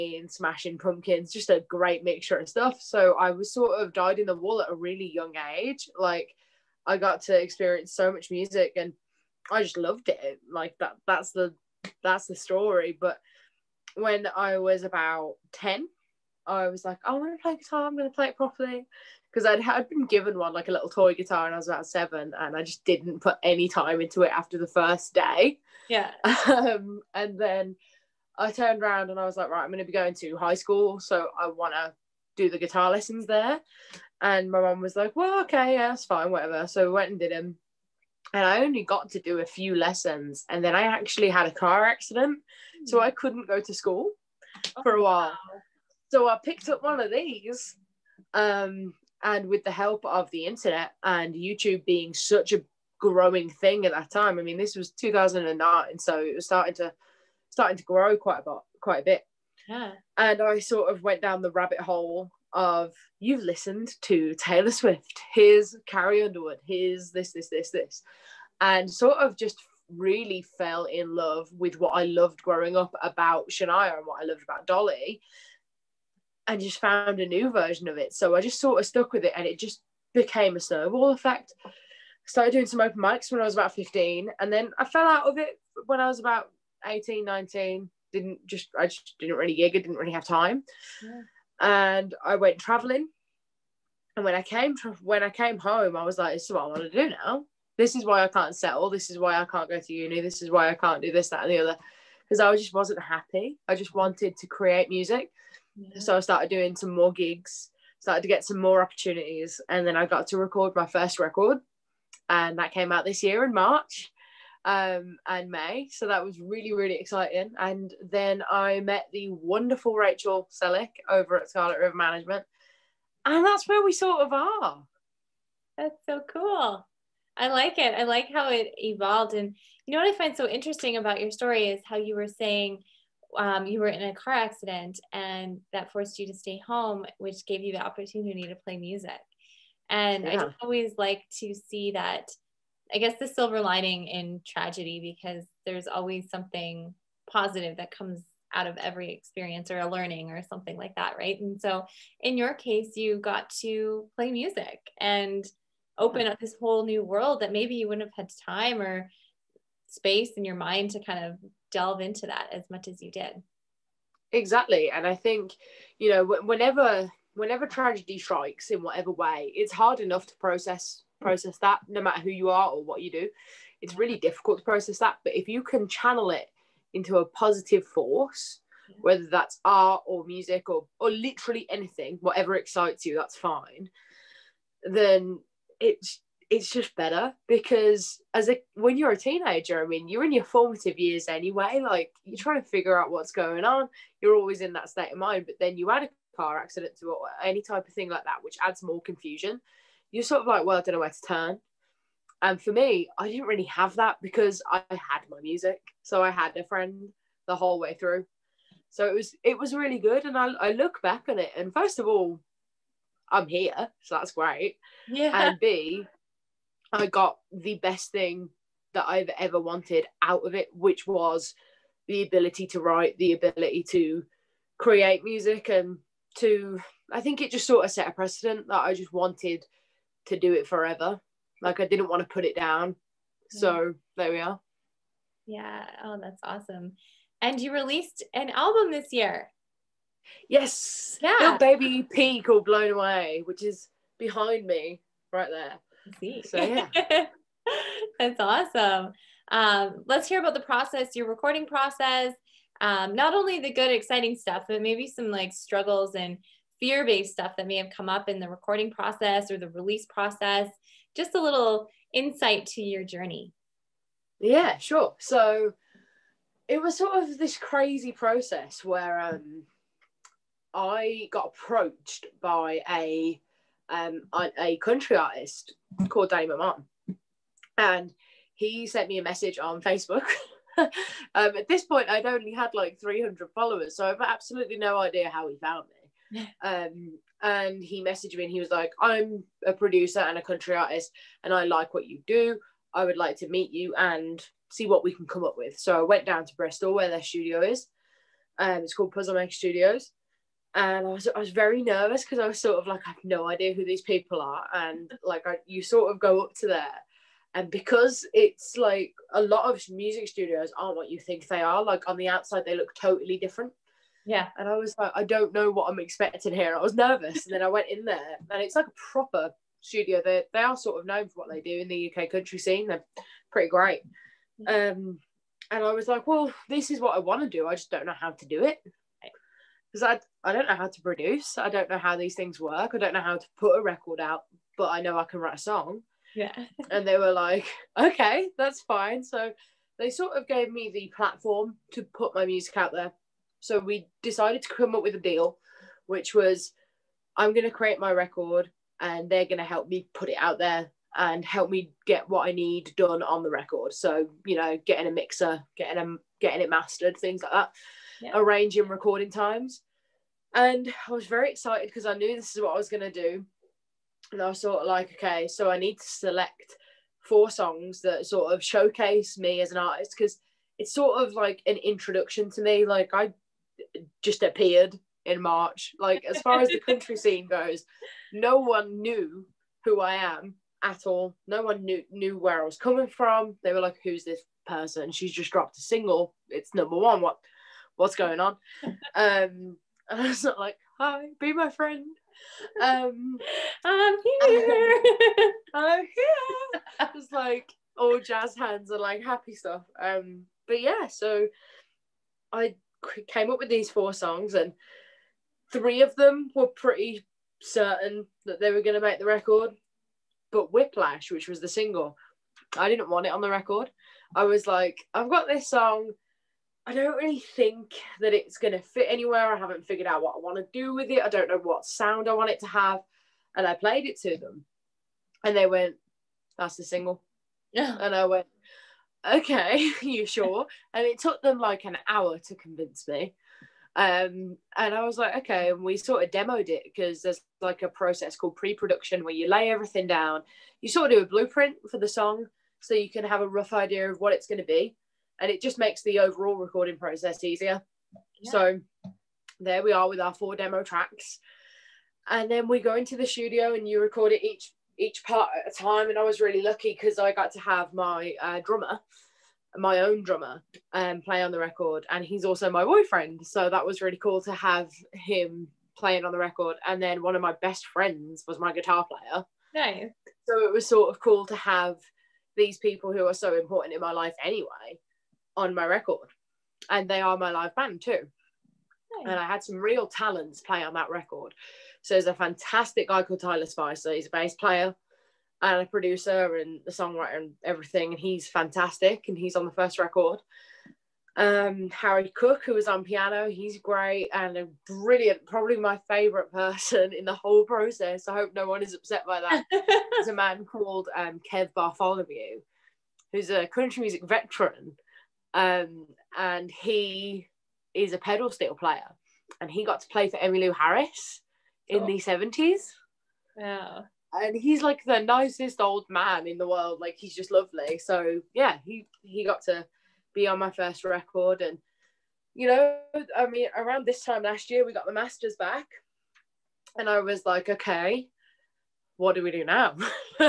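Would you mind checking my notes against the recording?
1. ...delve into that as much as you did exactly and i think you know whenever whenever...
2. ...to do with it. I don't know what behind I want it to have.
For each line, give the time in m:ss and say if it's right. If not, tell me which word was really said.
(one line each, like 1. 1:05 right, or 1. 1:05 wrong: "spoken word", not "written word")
1. 2:41 right
2. 7:00 wrong: "sound", not "behind".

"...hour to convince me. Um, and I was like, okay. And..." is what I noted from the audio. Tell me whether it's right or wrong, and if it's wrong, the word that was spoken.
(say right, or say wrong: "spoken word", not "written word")
right.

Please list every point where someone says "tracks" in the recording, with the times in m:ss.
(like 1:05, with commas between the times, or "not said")
7:30.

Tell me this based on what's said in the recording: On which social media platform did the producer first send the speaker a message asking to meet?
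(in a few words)
Facebook.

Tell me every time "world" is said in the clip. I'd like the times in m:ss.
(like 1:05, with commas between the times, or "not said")
2:37, 8:36.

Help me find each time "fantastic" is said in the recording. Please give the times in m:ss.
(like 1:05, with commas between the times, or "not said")
8:02, 8:08.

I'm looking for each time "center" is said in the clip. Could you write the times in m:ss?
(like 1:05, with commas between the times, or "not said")
not said.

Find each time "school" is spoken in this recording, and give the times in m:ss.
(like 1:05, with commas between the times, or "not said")
0:30, 0:43.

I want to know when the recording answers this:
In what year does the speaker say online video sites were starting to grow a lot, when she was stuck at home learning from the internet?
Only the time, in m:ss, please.
0:54.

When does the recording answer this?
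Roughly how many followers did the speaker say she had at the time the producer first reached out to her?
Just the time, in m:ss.
4:42.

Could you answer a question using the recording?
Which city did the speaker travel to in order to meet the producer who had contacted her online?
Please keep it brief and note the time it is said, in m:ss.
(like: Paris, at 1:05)
Bristol, at 4:56.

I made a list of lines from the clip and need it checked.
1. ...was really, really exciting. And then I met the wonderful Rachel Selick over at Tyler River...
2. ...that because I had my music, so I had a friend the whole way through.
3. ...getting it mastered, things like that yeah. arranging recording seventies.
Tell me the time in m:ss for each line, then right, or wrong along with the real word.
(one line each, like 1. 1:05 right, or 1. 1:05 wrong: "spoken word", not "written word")
1. 1:56 wrong: "Scarlet", not "Tyler"
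2. 3:23 right
3. 5:56 wrong: "times", not "seventies".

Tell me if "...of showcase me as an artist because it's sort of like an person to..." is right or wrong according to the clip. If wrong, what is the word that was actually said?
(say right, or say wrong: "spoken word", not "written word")
wrong: "introduction", not "person".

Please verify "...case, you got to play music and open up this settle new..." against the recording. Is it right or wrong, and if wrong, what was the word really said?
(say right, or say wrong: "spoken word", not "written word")
wrong: "whole", not "settle".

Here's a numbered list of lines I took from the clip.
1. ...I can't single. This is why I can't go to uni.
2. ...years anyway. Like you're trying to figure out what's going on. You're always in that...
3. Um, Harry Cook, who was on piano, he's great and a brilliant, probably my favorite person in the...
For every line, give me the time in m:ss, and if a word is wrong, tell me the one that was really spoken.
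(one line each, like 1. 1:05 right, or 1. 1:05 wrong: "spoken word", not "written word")
1. 1:38 wrong: "settle", not "single"
2. 3:10 right
3. 8:11 right.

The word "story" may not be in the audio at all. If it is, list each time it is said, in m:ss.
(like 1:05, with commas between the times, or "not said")
0:12, 2:11.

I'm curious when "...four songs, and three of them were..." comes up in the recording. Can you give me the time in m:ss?
6:43.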